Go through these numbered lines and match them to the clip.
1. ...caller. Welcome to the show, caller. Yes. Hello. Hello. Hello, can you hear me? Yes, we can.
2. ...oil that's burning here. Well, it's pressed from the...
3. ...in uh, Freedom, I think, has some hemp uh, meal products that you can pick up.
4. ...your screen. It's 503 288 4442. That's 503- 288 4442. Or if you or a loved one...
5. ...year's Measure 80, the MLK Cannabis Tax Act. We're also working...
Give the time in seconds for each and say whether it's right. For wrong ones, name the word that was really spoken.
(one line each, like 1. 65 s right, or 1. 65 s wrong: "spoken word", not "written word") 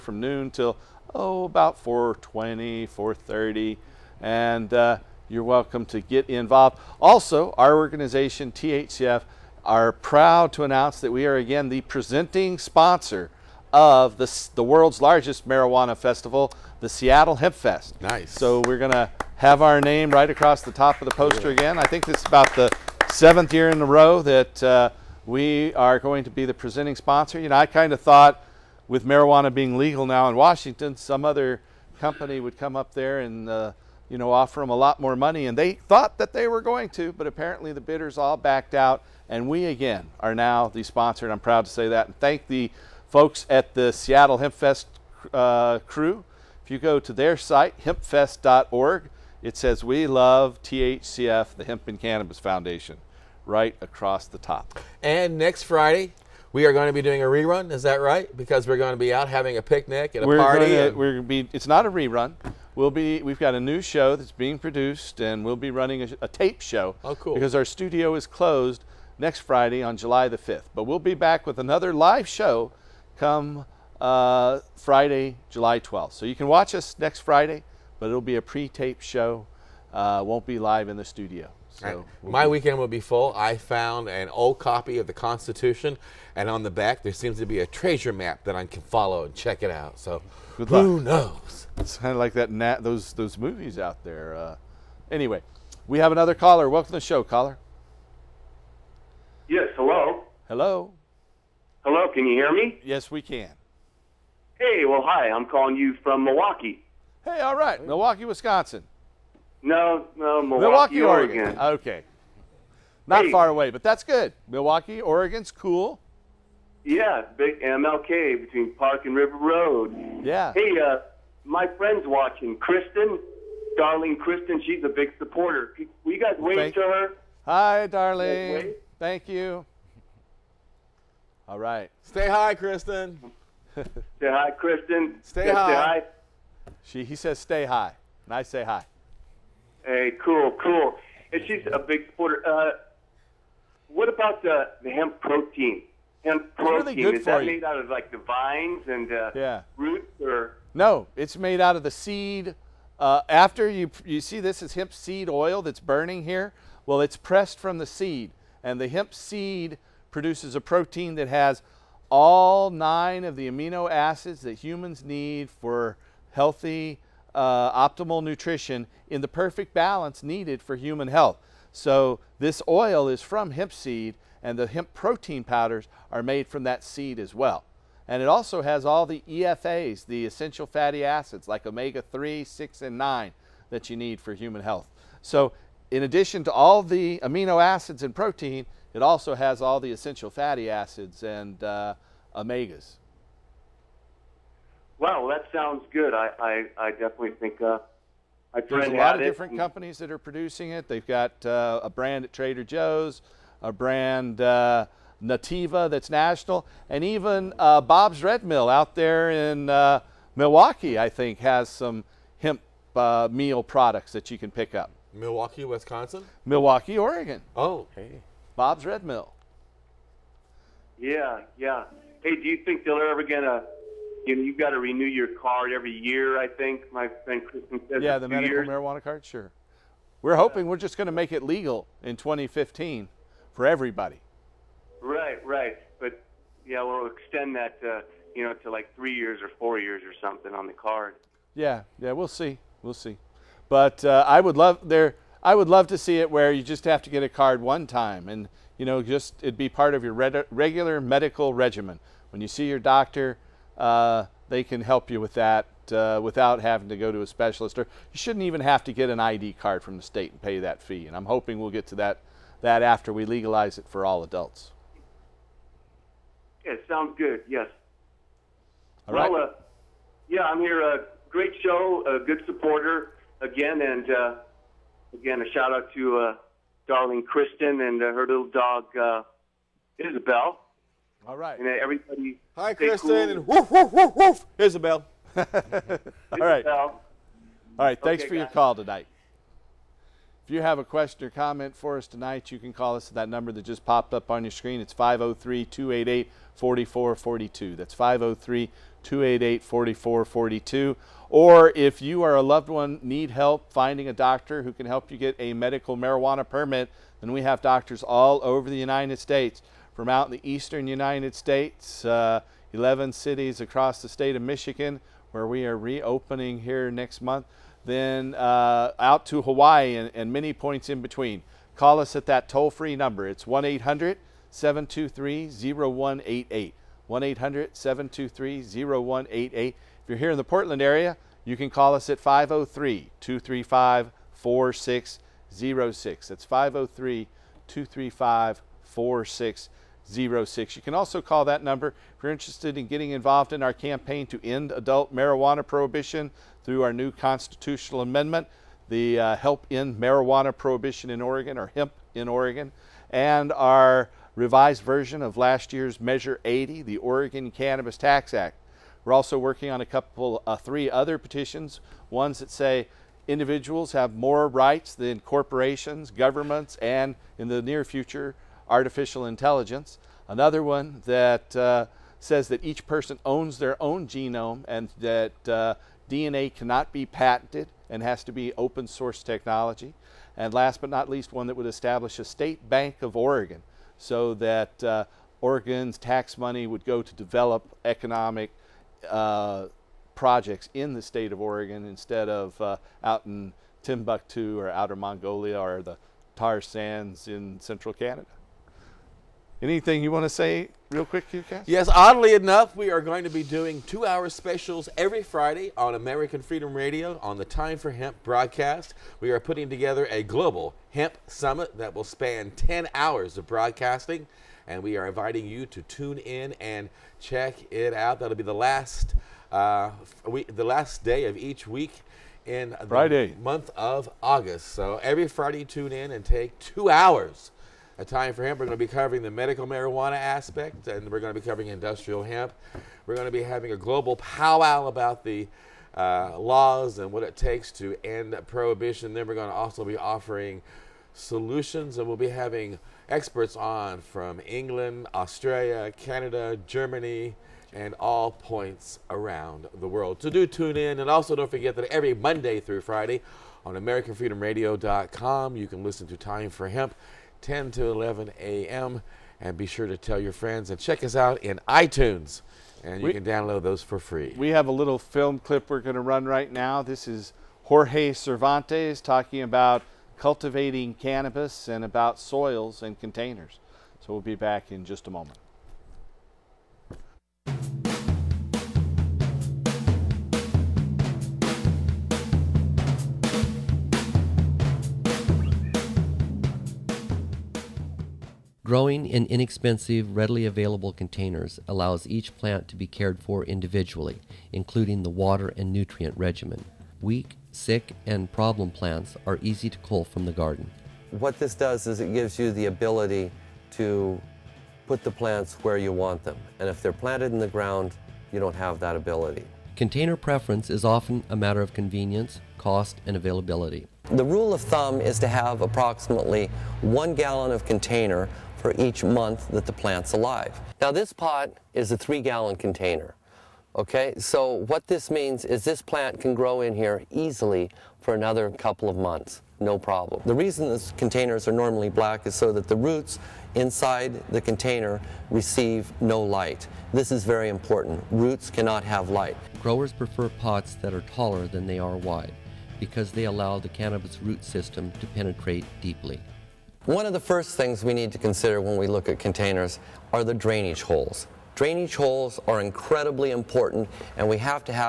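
1. 96 s right
2. 155 s right
3. 209 s wrong: "Milwaukie", not "Freedom"
4. 294 s right
5. 355 s wrong: "Oregon", not "MLK".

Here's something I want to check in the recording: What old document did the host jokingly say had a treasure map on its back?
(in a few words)
The Constitution.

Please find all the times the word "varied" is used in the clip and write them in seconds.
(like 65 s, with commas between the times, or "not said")
not said.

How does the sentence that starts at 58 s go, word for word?
Because we're going to be out having a picnic and a we're party.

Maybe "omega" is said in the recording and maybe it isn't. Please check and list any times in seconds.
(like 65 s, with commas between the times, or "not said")
181 s, 192 s.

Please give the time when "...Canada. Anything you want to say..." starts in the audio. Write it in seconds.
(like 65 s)
397 s.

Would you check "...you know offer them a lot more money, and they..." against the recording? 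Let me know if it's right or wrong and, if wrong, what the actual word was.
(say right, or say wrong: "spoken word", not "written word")
right.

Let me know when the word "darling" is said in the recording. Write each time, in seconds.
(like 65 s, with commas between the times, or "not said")
123 s, 127 s, 276 s.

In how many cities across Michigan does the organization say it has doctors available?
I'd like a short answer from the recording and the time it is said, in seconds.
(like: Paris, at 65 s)
11, at 312 s.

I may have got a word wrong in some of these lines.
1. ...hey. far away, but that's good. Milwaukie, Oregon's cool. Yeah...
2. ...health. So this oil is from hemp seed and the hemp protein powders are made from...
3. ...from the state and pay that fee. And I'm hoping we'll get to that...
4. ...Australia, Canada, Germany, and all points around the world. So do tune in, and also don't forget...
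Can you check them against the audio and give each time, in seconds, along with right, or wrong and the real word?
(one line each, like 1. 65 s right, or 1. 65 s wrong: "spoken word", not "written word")
1. 113 s right
2. 171 s right
3. 259 s right
4. 445 s right.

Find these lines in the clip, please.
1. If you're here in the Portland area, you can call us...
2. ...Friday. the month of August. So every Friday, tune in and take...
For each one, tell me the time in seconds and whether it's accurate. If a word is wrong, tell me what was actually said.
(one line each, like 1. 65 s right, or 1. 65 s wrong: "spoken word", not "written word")
1. 329 s right
2. 422 s right.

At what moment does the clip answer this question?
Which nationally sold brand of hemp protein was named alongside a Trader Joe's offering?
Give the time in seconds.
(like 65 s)
205 s.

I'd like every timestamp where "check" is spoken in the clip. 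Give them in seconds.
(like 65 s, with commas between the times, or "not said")
89 s, 417 s, 460 s.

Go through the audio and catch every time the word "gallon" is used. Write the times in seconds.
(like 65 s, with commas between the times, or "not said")
517 s, 522 s.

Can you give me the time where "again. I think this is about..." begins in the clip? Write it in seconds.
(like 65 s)
21 s.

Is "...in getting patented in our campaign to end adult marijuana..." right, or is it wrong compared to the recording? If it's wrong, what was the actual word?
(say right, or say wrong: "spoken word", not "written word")
wrong: "involved", not "patented".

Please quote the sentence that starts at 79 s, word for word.
Uh, won't be live in the studio.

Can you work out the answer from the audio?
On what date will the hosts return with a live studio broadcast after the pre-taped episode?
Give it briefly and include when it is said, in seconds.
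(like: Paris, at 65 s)
July 12, at 75 s.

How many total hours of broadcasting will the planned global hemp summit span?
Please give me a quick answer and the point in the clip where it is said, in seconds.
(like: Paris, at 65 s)
10 hours, at 412 s.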